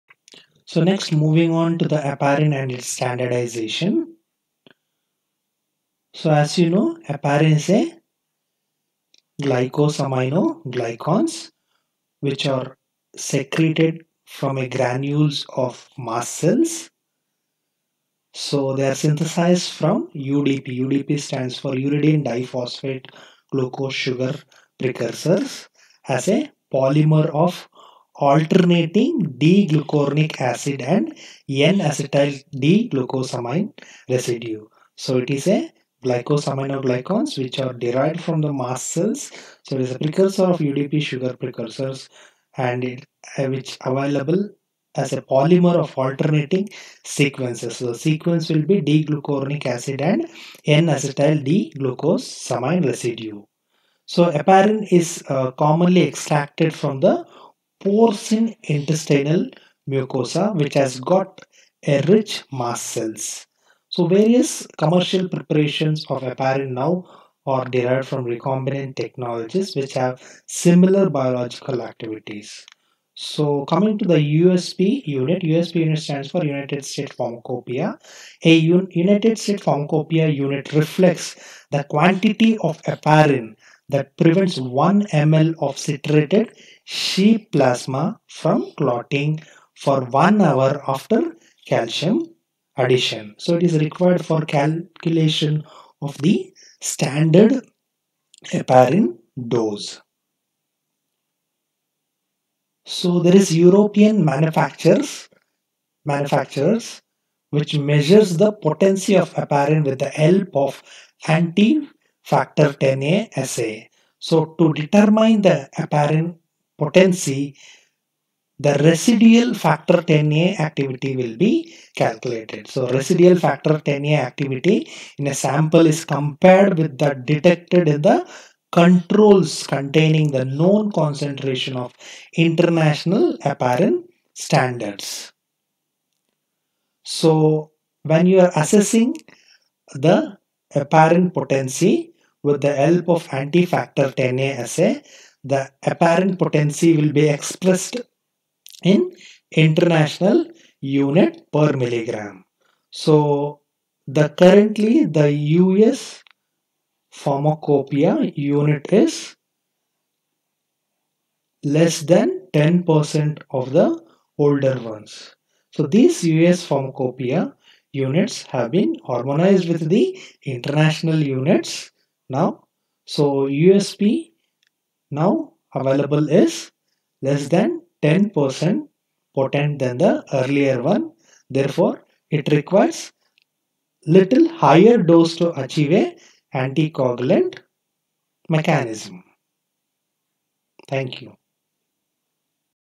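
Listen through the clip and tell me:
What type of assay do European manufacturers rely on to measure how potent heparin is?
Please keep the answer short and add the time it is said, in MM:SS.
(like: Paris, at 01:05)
Anti-factor 10a assay, at 01:51.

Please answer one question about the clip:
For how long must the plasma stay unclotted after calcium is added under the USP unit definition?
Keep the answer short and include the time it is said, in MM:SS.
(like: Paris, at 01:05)
1 hour, at 01:30.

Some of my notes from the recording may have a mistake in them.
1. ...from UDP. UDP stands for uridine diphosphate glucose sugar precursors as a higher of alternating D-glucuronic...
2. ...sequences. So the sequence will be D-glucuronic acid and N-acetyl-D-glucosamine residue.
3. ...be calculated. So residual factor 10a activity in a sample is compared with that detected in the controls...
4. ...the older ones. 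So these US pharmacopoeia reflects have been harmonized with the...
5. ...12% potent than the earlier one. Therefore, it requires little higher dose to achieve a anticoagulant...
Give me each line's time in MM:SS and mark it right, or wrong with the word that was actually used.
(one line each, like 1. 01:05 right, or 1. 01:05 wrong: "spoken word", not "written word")
1. 00:19 wrong: "polymer", not "higher"
2. 00:47 right
3. 02:01 right
4. 02:43 wrong: "units", not "reflects"
5. 02:58 wrong: "10", not "12".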